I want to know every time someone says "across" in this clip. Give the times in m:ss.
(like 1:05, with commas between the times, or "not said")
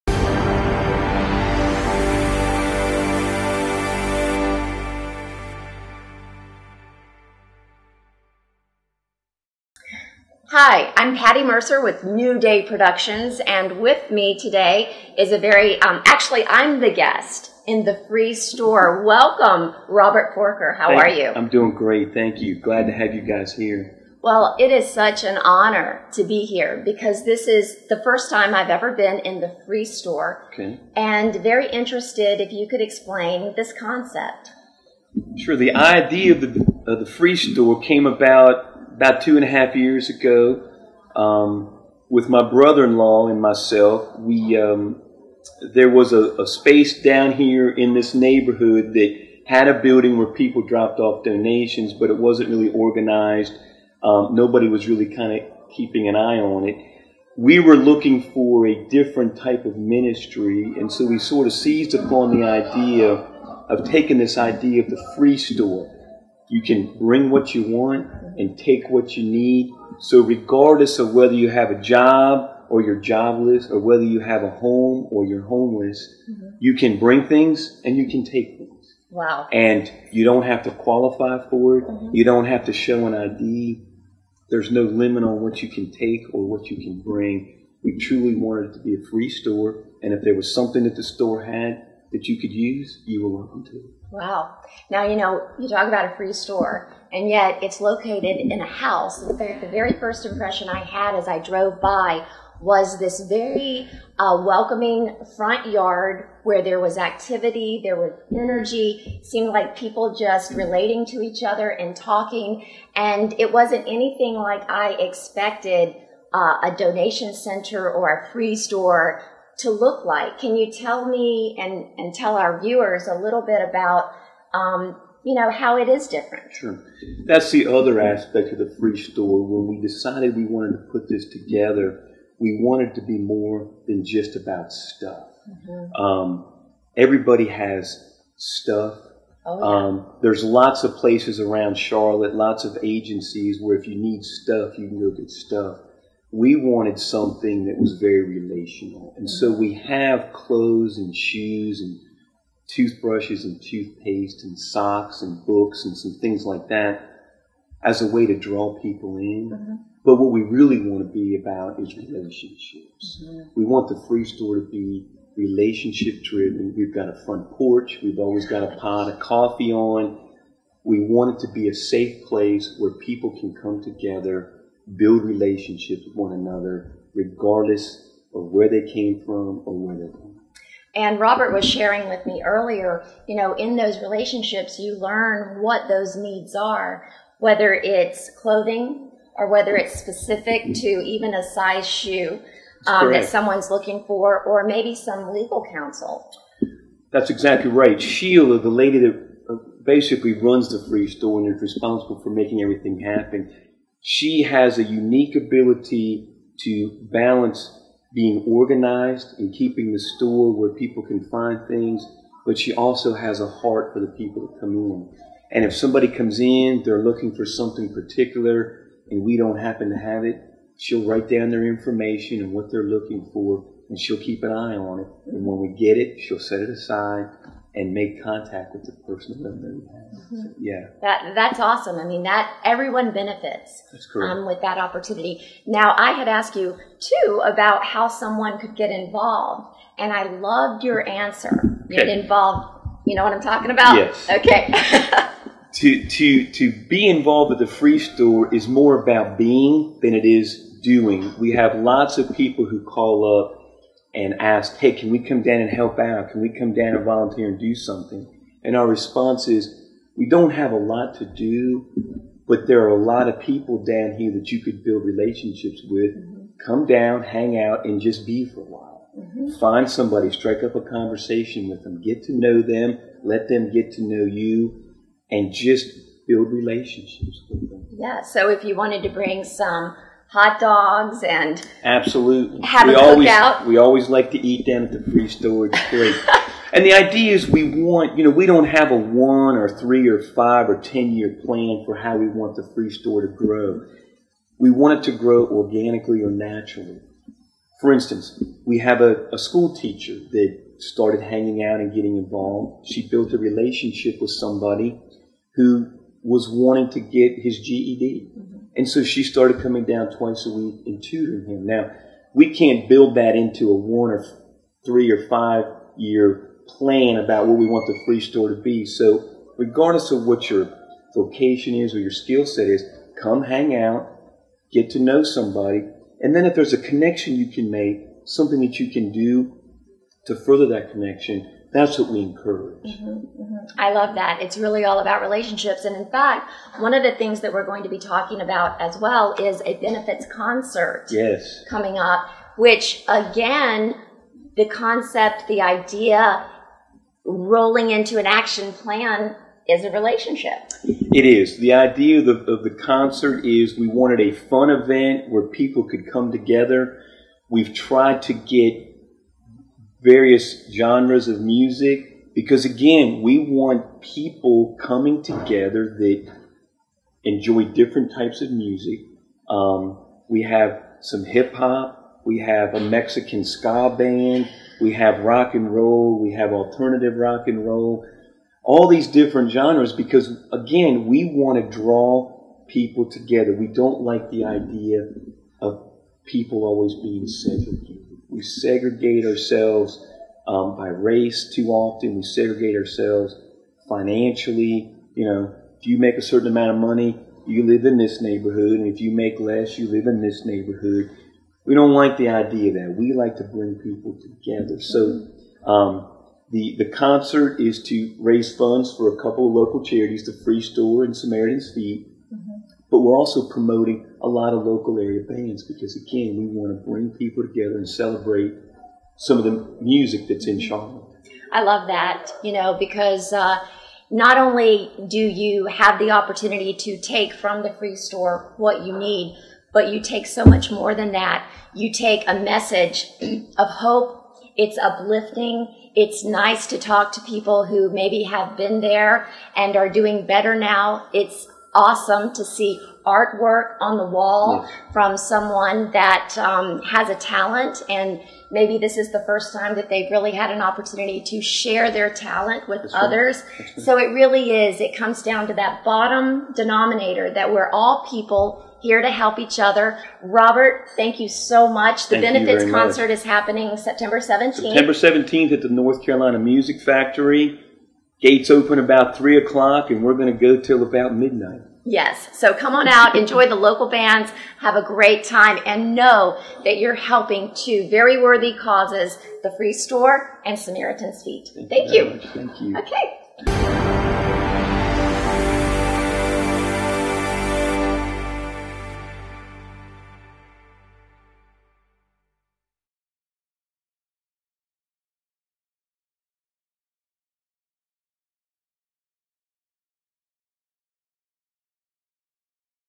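not said.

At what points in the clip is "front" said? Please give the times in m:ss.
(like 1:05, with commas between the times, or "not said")
1:45, 2:47.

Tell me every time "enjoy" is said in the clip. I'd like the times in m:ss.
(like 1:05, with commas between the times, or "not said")
6:07, 7:53.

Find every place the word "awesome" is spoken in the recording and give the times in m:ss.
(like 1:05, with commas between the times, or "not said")
3:51, 7:21.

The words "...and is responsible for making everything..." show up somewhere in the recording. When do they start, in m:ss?
3:21.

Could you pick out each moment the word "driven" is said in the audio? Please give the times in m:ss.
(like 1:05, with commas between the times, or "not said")
2:46.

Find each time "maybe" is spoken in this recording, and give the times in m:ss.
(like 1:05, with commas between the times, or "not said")
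3:14, 7:17, 7:28.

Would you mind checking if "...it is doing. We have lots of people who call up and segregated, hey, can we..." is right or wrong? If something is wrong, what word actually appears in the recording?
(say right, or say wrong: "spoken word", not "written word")
wrong: "asked", not "segregated".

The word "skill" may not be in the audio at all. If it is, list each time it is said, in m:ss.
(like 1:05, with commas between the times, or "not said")
5:22.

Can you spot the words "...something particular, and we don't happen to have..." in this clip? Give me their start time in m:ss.
3:37.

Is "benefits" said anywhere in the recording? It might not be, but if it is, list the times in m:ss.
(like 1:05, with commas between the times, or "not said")
3:53, 5:39, 7:42.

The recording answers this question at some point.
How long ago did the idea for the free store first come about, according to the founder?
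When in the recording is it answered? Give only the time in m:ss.
0:39.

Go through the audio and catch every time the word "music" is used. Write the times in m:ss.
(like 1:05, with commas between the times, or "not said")
6:01, 6:08, 6:59, 7:46.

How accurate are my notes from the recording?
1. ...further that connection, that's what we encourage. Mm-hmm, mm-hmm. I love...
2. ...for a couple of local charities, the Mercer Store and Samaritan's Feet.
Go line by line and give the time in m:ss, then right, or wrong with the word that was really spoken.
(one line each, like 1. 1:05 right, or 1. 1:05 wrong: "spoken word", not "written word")
1. 5:30 right
2. 6:48 wrong: "Free", not "Mercer".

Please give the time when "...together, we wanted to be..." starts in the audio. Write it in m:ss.
2:11.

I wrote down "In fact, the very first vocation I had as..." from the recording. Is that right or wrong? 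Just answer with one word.
wrong.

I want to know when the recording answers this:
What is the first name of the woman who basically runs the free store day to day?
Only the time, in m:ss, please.
3:18.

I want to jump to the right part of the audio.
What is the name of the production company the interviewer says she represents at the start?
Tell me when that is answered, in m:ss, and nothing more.
0:12.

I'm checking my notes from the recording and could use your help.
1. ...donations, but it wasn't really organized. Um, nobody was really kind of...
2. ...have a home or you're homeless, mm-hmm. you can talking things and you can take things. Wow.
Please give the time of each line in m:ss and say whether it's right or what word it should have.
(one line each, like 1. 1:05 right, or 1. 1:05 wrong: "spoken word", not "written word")
1. 0:51 right
2. 1:14 wrong: "bring", not "talking".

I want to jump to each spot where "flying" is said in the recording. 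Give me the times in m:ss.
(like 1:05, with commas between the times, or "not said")
not said.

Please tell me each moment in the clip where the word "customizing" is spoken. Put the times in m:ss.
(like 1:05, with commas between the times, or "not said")
not said.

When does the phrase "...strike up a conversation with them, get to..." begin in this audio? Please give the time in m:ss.
4:30.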